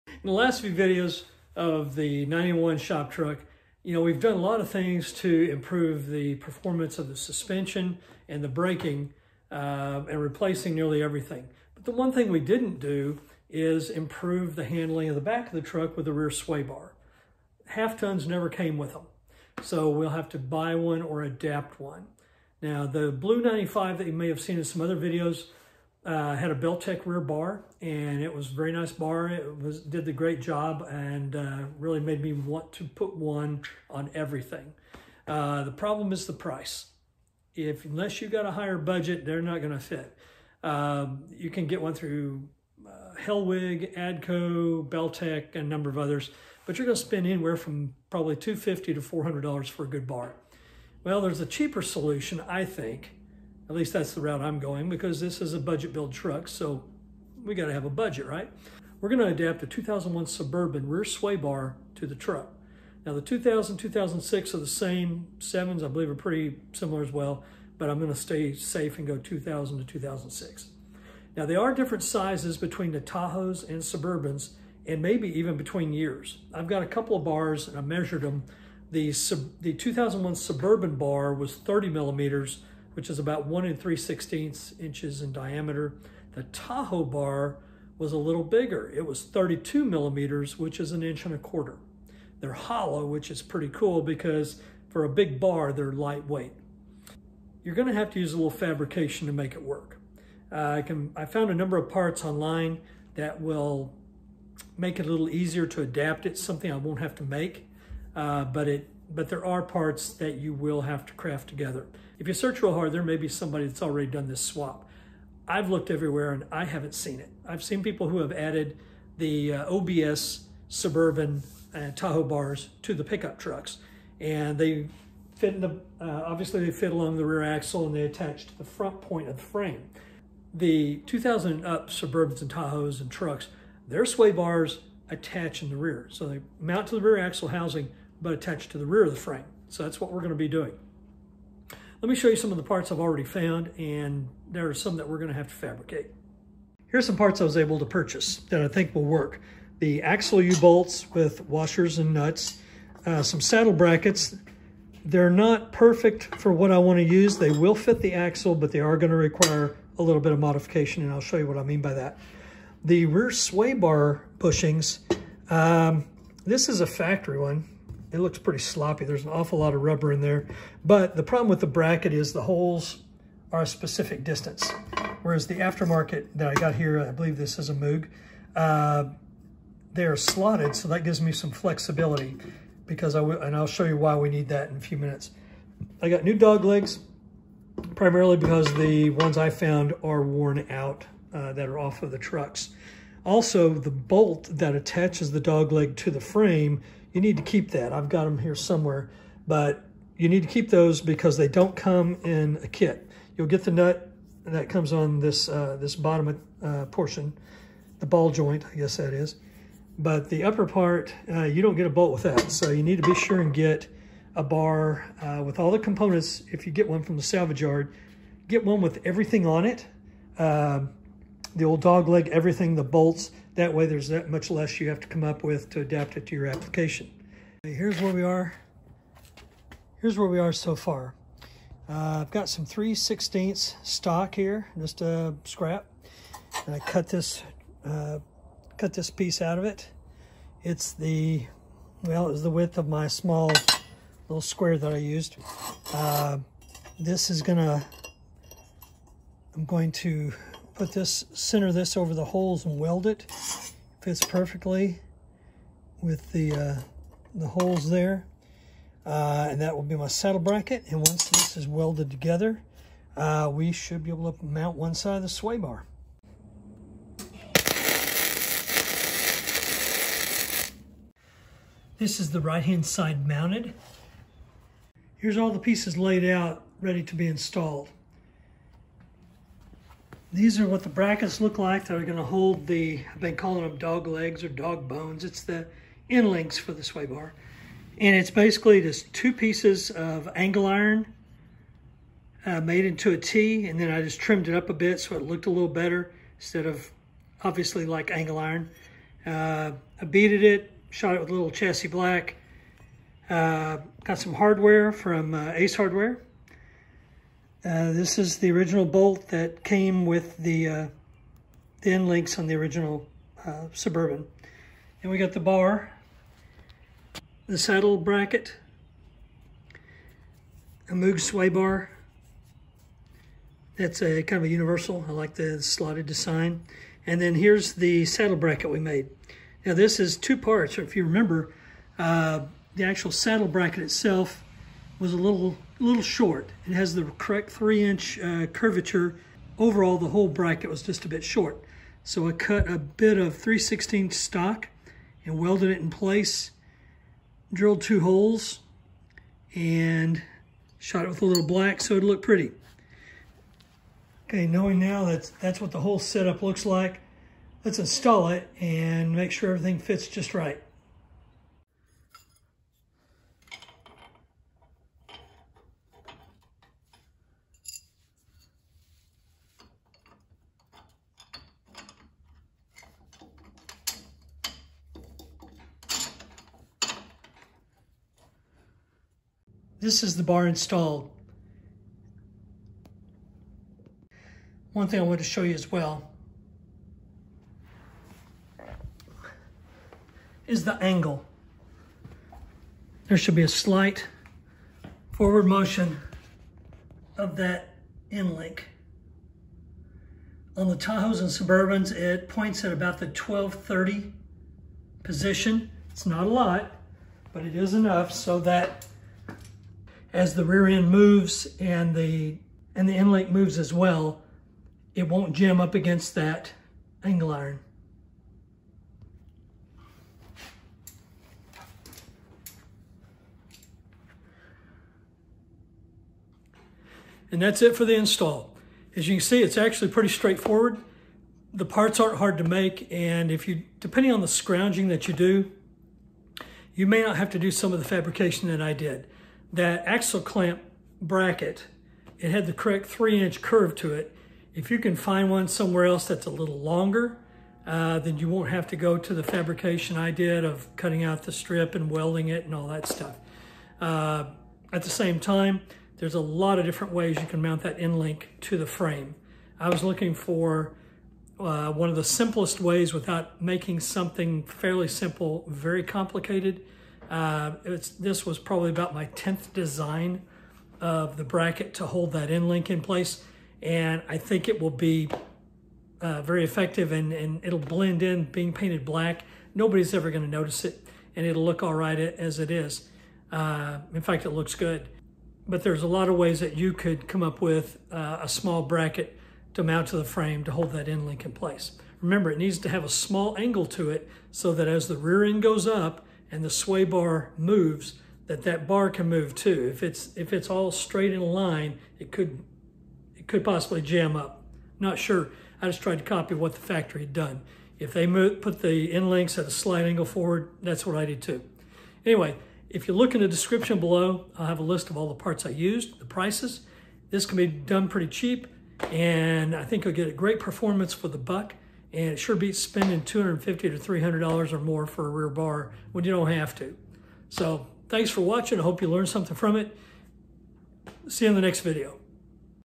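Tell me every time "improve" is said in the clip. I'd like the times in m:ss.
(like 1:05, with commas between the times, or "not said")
0:05, 0:13.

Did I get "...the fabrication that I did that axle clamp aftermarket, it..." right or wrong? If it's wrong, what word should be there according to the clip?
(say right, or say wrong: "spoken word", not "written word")
wrong: "bracket", not "aftermarket".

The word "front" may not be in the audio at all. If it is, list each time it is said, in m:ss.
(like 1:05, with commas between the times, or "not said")
2:08.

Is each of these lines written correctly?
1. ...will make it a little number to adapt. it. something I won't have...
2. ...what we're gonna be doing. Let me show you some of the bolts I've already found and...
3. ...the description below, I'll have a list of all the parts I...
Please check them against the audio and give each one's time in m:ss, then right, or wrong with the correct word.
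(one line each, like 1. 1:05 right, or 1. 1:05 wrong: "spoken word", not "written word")
1. 1:43 wrong: "easier", not "number"
2. 2:19 wrong: "parts", not "bolts"
3. 8:33 right.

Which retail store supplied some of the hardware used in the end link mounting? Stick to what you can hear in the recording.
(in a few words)
Ace Hardware.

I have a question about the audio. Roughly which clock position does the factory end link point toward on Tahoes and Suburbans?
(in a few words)
12:30.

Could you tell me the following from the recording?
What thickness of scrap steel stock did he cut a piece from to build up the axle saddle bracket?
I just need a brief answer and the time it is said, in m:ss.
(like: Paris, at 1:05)
3/16, at 3:52.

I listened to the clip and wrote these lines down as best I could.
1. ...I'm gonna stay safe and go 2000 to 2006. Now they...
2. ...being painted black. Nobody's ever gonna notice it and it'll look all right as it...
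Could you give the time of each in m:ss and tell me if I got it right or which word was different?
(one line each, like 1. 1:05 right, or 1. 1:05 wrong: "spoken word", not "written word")
1. 1:07 right
2. 7:58 right.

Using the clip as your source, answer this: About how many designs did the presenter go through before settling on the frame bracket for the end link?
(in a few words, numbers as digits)
10.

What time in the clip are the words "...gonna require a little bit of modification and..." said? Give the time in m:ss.
2:38.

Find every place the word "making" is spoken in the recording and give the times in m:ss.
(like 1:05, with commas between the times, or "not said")
7:43.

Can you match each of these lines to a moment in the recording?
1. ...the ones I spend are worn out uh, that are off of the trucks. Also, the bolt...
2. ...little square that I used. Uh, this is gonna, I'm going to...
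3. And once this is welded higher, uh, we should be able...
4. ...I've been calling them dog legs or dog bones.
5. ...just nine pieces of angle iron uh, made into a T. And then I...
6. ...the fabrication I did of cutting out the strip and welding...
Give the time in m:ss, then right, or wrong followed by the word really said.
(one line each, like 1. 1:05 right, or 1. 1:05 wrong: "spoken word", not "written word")
1. 3:08 wrong: "found", not "spend"
2. 4:04 right
3. 4:20 wrong: "together", not "higher"
4. 4:43 right
5. 4:48 wrong: "two", not "nine"
6. 7:29 right.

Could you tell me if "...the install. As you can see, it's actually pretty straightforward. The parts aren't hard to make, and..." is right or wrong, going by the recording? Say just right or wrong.
right.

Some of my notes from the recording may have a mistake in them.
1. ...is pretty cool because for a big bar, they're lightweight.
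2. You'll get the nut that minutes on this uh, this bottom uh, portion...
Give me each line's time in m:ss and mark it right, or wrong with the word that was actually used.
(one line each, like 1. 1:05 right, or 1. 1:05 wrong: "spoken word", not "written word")
1. 1:33 right
2. 3:23 wrong: "comes", not "minutes".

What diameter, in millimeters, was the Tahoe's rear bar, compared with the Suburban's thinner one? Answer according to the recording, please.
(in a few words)
32 millimeters.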